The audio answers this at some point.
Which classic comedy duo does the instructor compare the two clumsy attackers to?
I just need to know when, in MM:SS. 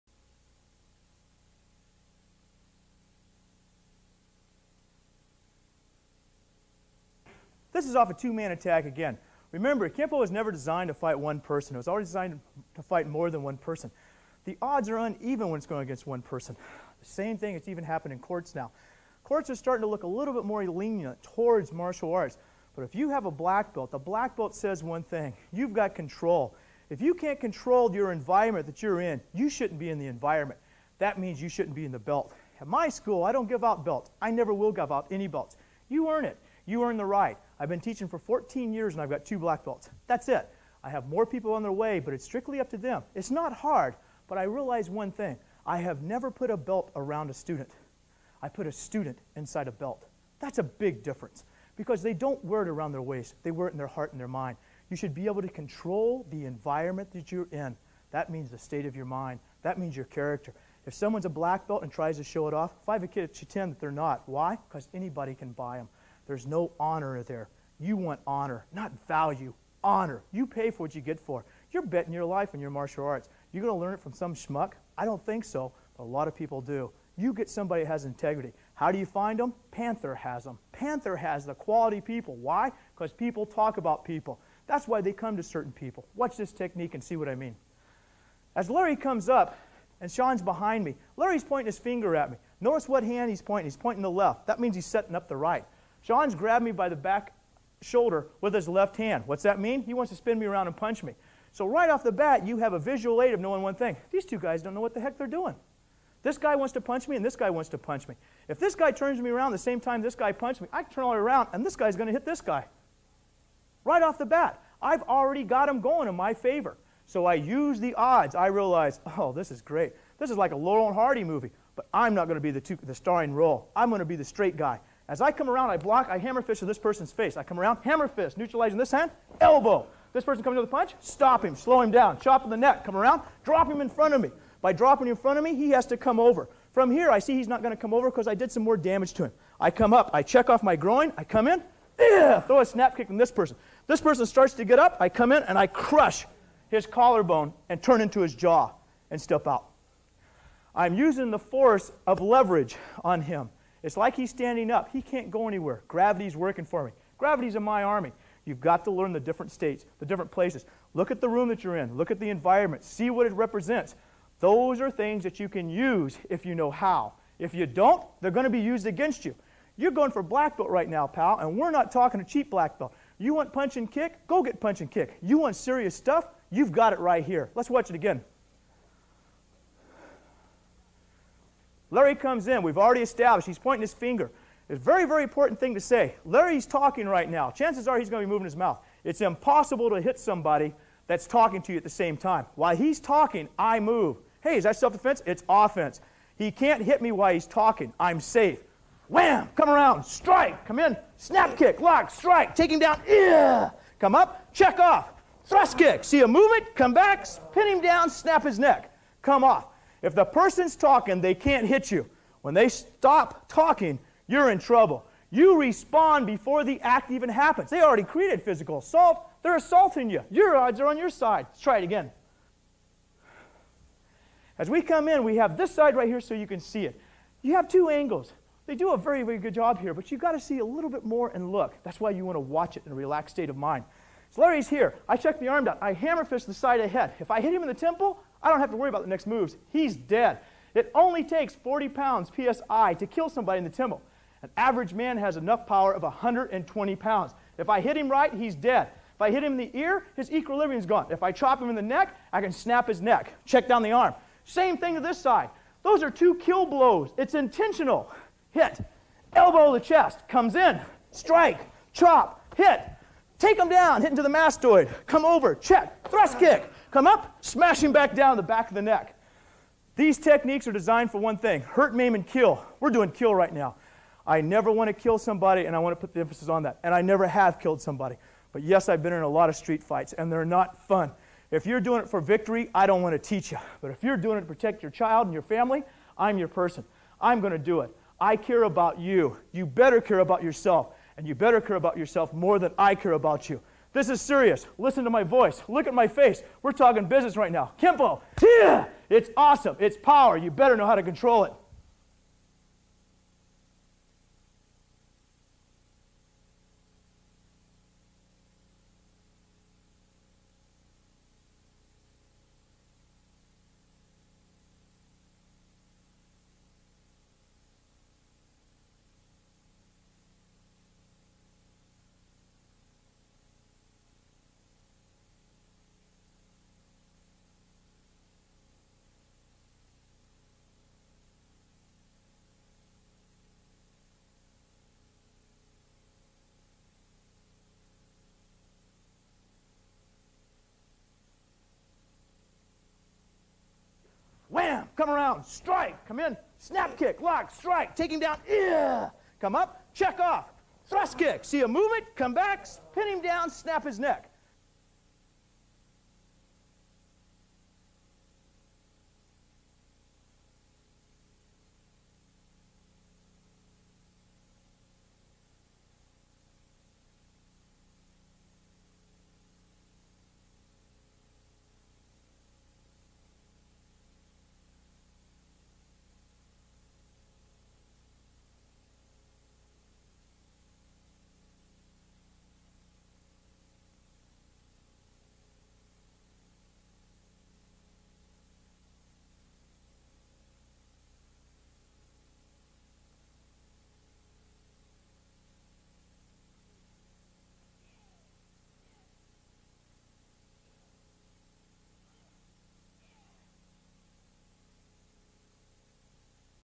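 02:00.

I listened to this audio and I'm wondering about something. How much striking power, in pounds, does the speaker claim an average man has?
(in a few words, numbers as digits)
120.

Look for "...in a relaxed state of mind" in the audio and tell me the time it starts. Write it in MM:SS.
03:52.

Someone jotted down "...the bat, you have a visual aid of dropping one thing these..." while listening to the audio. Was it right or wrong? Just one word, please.
wrong.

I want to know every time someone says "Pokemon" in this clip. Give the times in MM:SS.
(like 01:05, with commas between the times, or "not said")
not said.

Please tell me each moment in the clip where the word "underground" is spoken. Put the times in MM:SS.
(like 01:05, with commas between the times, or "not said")
not said.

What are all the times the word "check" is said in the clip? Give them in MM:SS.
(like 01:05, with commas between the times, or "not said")
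02:20, 03:24, 03:55, 04:13, 04:25, 05:49.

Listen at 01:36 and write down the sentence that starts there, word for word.
Sean's grabbed me by the back shoulder with his left hand.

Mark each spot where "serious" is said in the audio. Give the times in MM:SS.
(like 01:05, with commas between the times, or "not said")
02:55, 04:54.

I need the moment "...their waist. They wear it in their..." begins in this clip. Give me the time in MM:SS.
00:52.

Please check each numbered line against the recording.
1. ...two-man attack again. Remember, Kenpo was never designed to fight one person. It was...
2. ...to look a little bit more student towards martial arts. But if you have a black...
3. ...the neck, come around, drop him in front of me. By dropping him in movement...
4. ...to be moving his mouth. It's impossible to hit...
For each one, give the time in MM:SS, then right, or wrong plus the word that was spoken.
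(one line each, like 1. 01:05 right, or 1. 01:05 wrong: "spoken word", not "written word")
1. 00:08 right
2. 00:19 wrong: "lenient", not "student"
3. 02:12 wrong: "front", not "movement"
4. 03:08 right.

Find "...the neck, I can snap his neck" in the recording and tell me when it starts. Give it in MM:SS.
04:11.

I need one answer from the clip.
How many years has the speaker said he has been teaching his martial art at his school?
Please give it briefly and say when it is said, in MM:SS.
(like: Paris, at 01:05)
14, at 00:38.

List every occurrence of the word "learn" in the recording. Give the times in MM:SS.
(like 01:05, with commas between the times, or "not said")
01:13, 02:38.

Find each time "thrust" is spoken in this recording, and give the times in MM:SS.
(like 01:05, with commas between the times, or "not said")
03:25, 04:26, 05:50.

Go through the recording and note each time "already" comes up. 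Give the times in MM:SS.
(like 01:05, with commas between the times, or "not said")
01:55, 03:02, 03:37.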